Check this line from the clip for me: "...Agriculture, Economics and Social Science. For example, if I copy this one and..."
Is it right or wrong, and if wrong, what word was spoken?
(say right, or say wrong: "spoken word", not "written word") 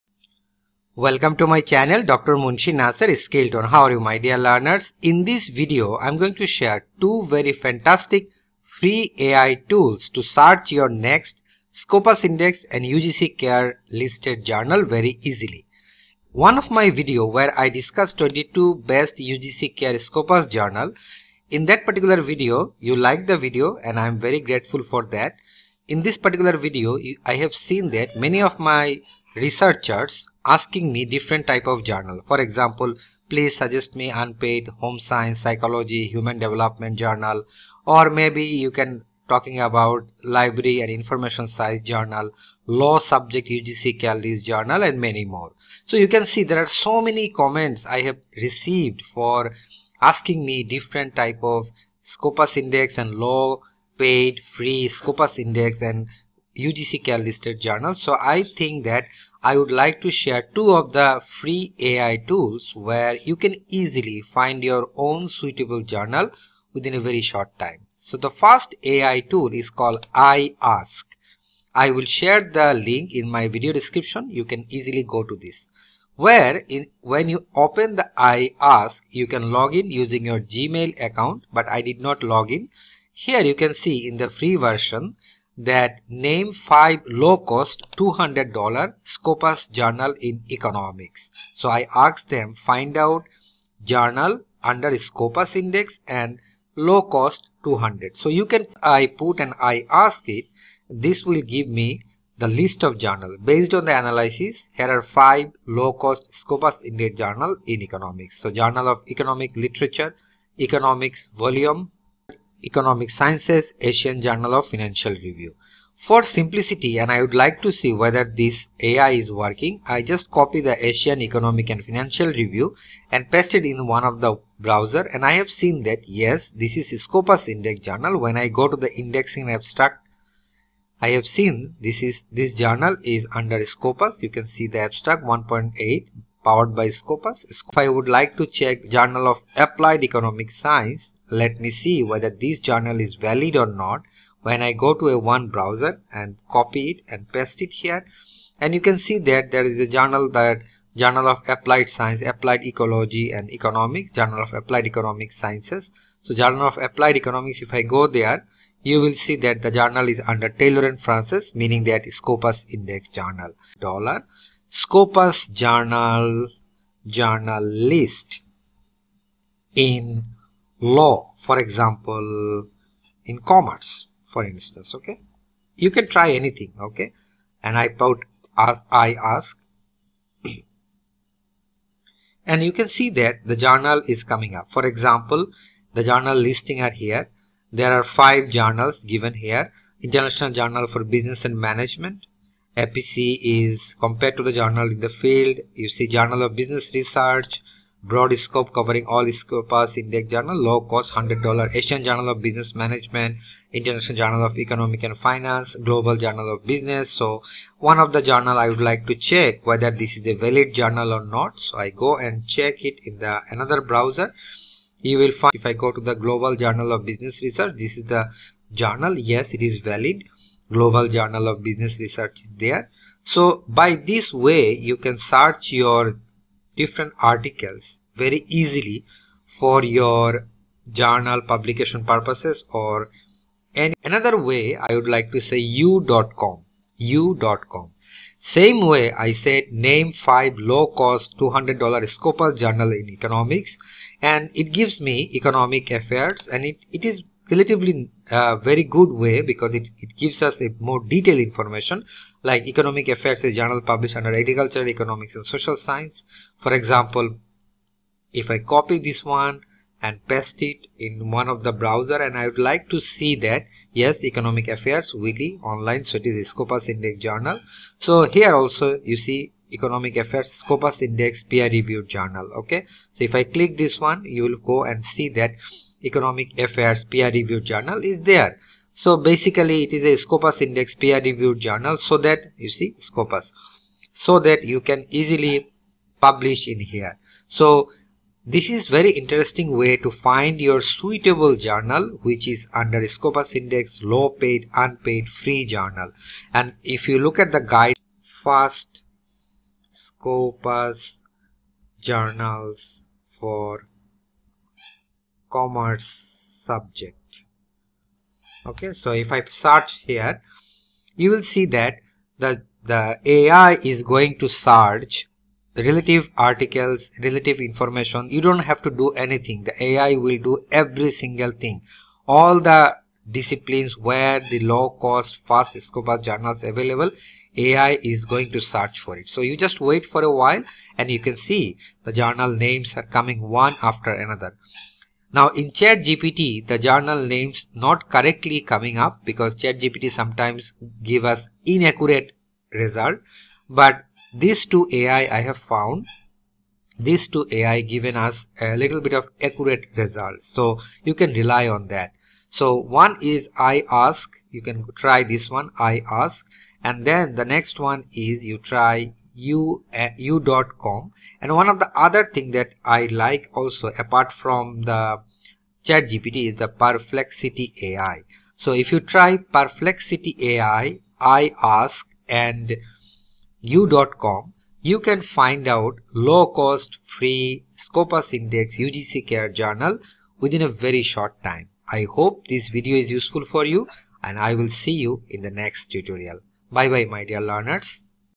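right.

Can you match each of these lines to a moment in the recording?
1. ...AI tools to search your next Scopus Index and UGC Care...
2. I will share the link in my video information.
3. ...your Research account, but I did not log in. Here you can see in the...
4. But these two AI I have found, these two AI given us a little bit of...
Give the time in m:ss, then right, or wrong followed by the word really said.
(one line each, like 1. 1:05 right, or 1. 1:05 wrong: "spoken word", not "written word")
1. 0:09 right
2. 1:11 wrong: "description", not "information"
3. 1:20 wrong: "Gmail", not "Research"
4. 5:43 right.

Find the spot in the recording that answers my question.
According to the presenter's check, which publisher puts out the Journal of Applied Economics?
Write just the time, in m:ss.
2:40.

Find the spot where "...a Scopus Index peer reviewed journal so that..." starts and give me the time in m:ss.
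4:40.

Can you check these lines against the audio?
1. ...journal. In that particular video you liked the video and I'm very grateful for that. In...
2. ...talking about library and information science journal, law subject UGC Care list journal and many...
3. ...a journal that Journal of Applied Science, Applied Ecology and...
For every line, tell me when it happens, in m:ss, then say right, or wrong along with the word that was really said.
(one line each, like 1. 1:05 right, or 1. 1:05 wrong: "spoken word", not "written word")
1. 0:20 right
2. 0:39 right
3. 2:29 right.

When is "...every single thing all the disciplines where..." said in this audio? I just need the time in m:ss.
5:20.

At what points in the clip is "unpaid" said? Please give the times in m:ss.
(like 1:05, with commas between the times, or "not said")
0:34, 4:54.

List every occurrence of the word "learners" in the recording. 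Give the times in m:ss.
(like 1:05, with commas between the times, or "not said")
0:04, 6:27.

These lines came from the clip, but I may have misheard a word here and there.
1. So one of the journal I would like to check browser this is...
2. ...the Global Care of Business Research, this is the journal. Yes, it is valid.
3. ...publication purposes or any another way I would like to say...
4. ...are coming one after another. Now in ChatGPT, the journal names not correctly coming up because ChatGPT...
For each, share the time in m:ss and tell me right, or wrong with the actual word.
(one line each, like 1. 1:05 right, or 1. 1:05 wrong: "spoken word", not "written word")
1. 3:27 wrong: "whether", not "browser"
2. 3:36 wrong: "Journal", not "Care"
3. 3:51 right
4. 5:32 right.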